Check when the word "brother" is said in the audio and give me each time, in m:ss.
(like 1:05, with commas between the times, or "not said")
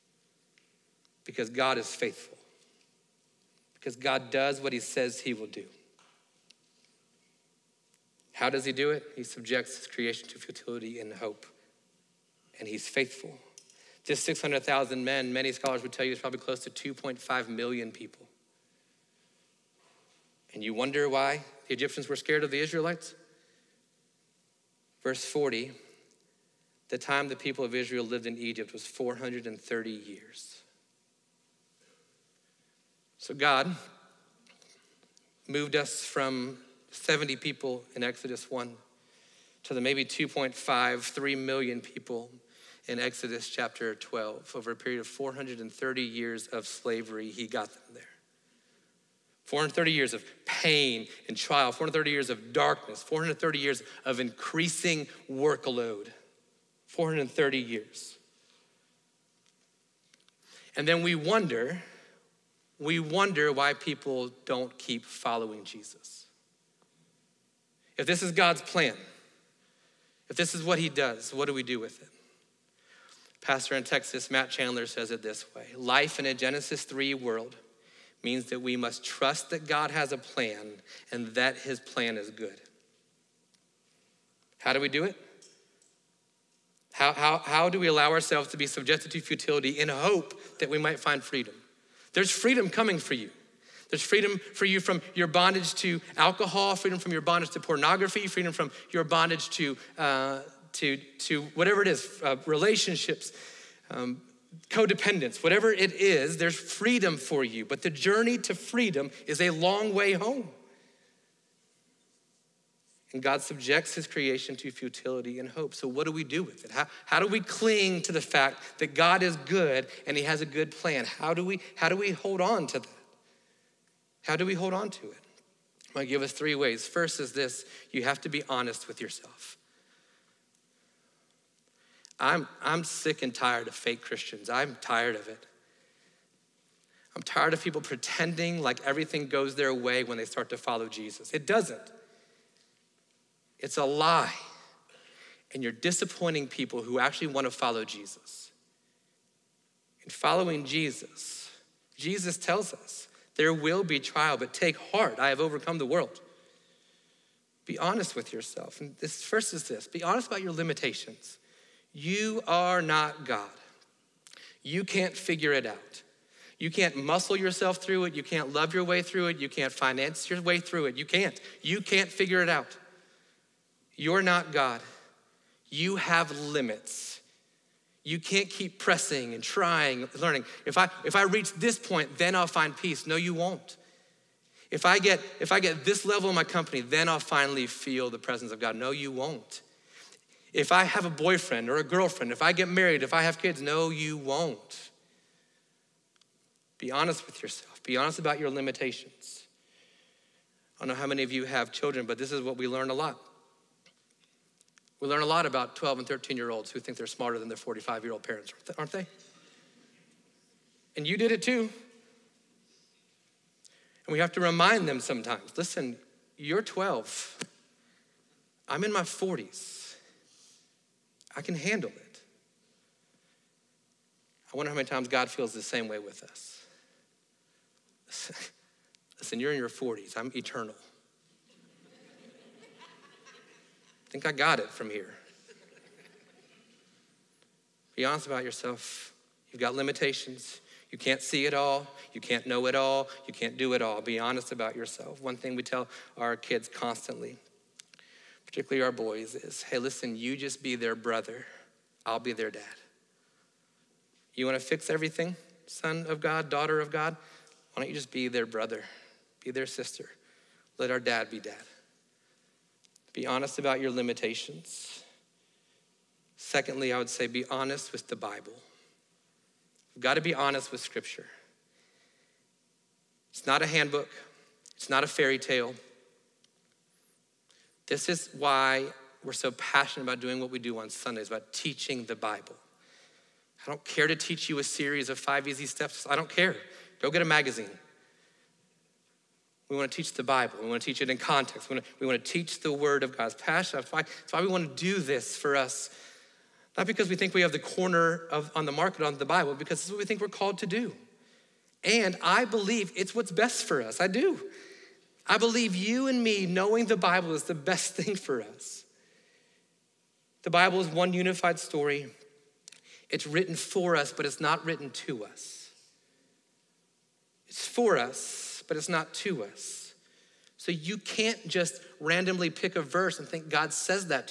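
4:10, 4:18.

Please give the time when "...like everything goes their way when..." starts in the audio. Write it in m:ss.
2:18.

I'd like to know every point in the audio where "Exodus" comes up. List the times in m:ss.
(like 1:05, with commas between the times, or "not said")
0:38, 0:42.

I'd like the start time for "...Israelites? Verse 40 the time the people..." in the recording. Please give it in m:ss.
0:22.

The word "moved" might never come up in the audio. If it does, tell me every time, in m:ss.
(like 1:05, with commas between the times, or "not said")
0:35.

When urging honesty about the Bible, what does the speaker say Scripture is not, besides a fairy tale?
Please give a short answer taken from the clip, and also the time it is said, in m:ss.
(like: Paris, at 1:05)
a handbook, at 4:33.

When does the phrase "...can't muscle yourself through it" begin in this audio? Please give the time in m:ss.
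2:46.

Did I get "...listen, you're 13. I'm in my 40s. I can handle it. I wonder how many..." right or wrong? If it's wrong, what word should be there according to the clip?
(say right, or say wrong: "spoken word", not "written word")
wrong: "12", not "13".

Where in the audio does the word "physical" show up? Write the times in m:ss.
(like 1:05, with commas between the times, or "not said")
not said.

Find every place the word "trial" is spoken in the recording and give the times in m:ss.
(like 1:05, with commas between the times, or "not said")
0:51, 2:34.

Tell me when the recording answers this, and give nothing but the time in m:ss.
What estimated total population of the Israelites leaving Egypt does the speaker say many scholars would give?
0:16.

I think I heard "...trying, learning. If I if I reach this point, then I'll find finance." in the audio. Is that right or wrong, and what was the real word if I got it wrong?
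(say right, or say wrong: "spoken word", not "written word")
wrong: "peace", not "finance".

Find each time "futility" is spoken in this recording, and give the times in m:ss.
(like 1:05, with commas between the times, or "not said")
0:10, 1:29, 1:54.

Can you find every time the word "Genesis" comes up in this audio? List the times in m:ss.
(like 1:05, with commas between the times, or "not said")
1:16.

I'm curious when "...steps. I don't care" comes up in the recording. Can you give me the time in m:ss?
4:45.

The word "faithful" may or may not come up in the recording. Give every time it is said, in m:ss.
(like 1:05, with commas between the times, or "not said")
0:01, 0:12.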